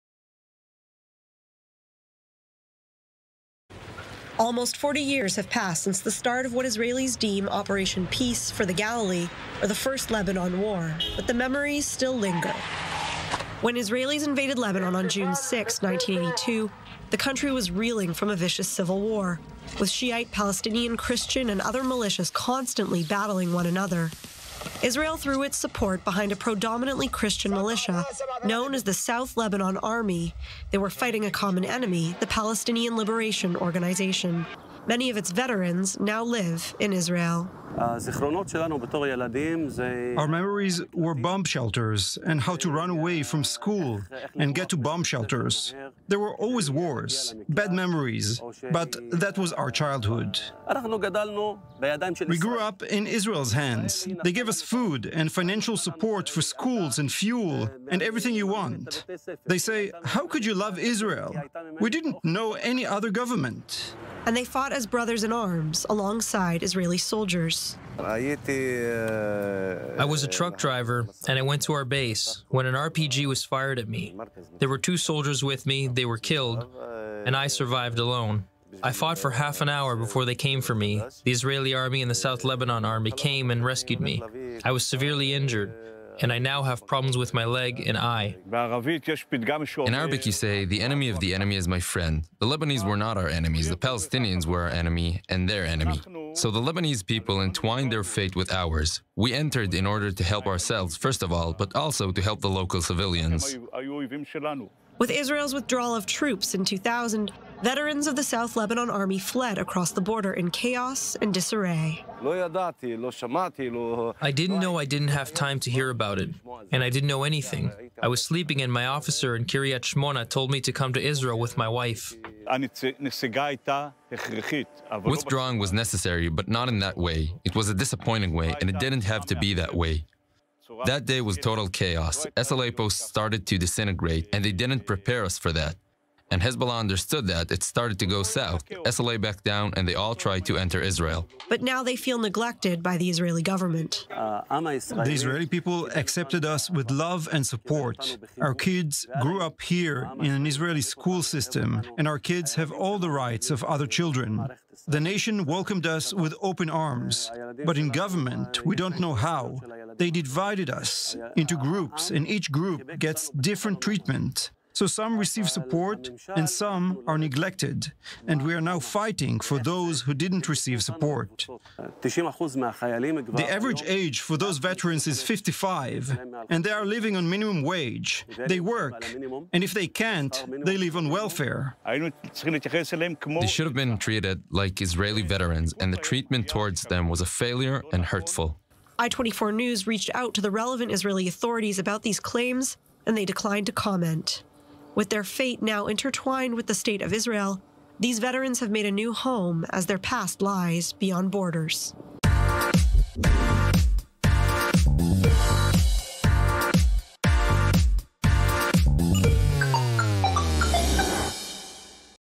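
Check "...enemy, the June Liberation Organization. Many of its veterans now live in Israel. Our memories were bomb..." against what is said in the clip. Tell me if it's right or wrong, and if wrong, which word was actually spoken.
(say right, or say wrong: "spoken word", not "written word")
wrong: "Palestinian", not "June".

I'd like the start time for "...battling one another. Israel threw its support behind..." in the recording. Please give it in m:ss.
0:23.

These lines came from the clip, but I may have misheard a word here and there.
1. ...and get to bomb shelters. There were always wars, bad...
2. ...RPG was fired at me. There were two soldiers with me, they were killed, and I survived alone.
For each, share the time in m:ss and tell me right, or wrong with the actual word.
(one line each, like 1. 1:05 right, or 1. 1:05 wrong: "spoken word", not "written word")
1. 0:44 right
2. 1:12 right.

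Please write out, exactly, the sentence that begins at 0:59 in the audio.
They say, How could you love Israel?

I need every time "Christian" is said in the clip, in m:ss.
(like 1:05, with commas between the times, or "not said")
0:20, 0:27.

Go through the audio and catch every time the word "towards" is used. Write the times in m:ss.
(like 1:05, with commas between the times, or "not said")
3:06.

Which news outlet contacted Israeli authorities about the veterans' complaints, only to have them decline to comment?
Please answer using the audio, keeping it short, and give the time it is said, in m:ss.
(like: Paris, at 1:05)
i24 News, at 3:08.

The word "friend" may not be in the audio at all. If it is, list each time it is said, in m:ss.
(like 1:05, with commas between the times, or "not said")
1:31.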